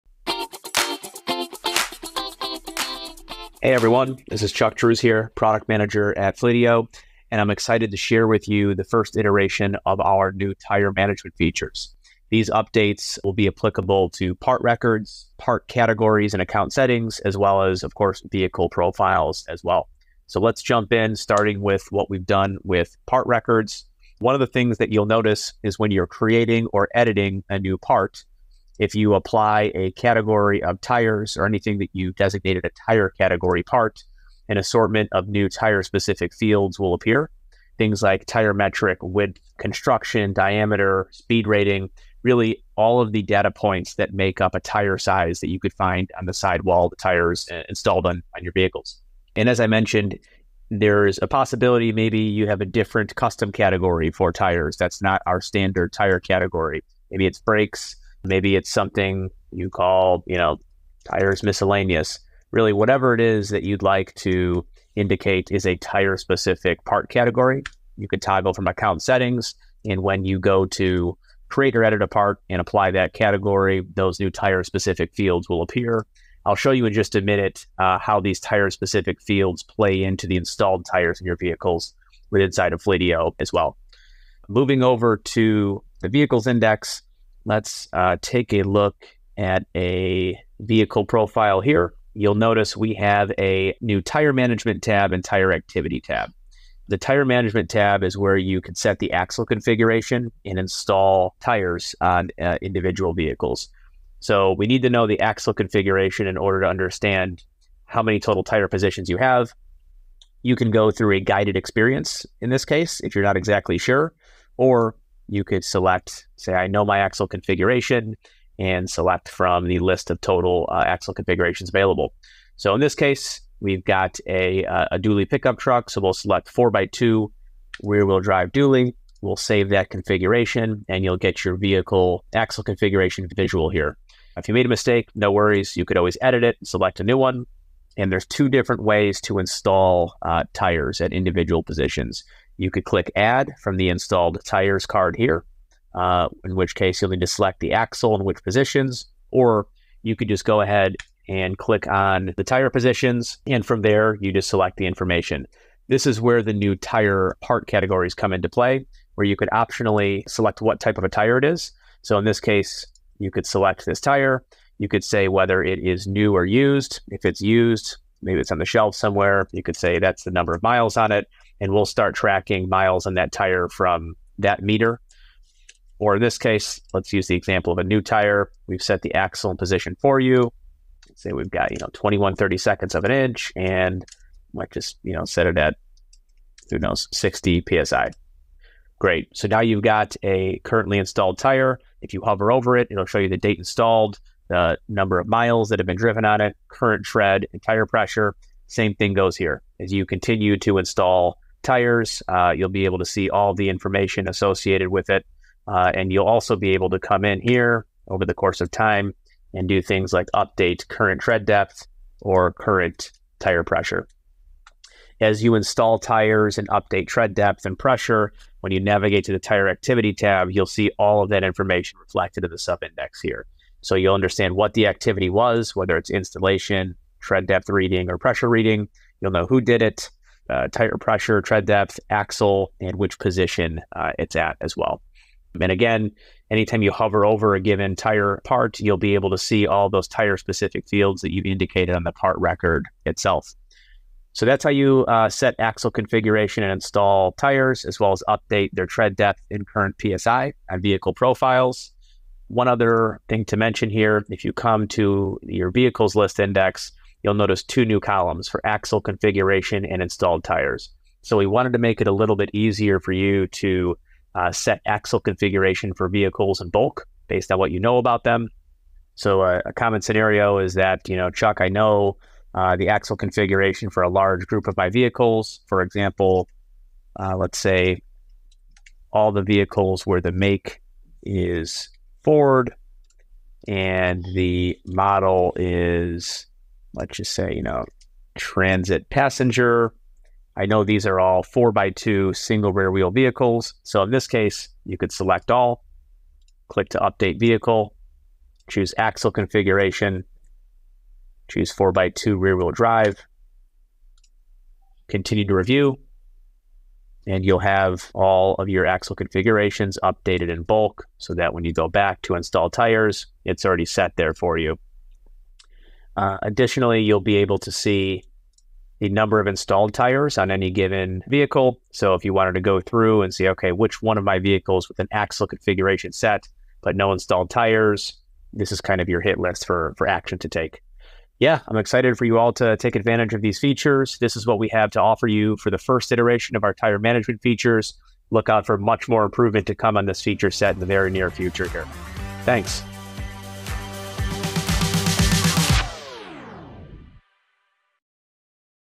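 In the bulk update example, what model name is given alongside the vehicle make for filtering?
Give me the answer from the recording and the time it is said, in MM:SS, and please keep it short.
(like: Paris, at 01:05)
Transit Passenger, at 04:48.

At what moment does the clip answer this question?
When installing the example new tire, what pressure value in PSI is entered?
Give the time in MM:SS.
03:07.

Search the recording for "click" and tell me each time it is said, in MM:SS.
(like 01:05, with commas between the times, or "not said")
02:22, 02:31, 04:56.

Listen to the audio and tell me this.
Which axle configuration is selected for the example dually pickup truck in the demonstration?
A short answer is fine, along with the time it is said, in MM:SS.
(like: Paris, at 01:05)
4x2 rear wheel drive dually, at 02:06.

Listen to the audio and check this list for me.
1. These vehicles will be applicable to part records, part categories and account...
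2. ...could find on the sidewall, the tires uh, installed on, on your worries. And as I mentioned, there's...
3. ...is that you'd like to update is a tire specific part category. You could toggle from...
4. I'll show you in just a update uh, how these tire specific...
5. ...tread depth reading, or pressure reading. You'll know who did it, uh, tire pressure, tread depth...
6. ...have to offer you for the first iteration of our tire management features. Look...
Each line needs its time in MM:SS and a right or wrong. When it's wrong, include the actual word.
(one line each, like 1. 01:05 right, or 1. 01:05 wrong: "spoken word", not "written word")
1. 00:12 wrong: "updates", not "vehicles"
2. 00:45 wrong: "vehicles", not "worries"
3. 01:03 wrong: "indicate", not "update"
4. 01:16 wrong: "minute", not "update"
5. 03:47 right
6. 05:34 right.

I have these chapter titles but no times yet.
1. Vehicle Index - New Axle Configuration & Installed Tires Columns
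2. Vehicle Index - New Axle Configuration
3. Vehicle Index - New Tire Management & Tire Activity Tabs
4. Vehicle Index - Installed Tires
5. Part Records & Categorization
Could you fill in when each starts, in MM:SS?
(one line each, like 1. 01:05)
1. 04:14
2. 04:30
3. 01:24
4. 05:22
5. 00:28.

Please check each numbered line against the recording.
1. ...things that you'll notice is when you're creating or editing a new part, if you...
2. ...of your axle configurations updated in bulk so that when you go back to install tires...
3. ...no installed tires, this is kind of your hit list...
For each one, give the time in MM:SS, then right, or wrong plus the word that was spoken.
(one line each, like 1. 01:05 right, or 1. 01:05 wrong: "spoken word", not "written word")
1. 00:24 right
2. 05:08 right
3. 05:26 right.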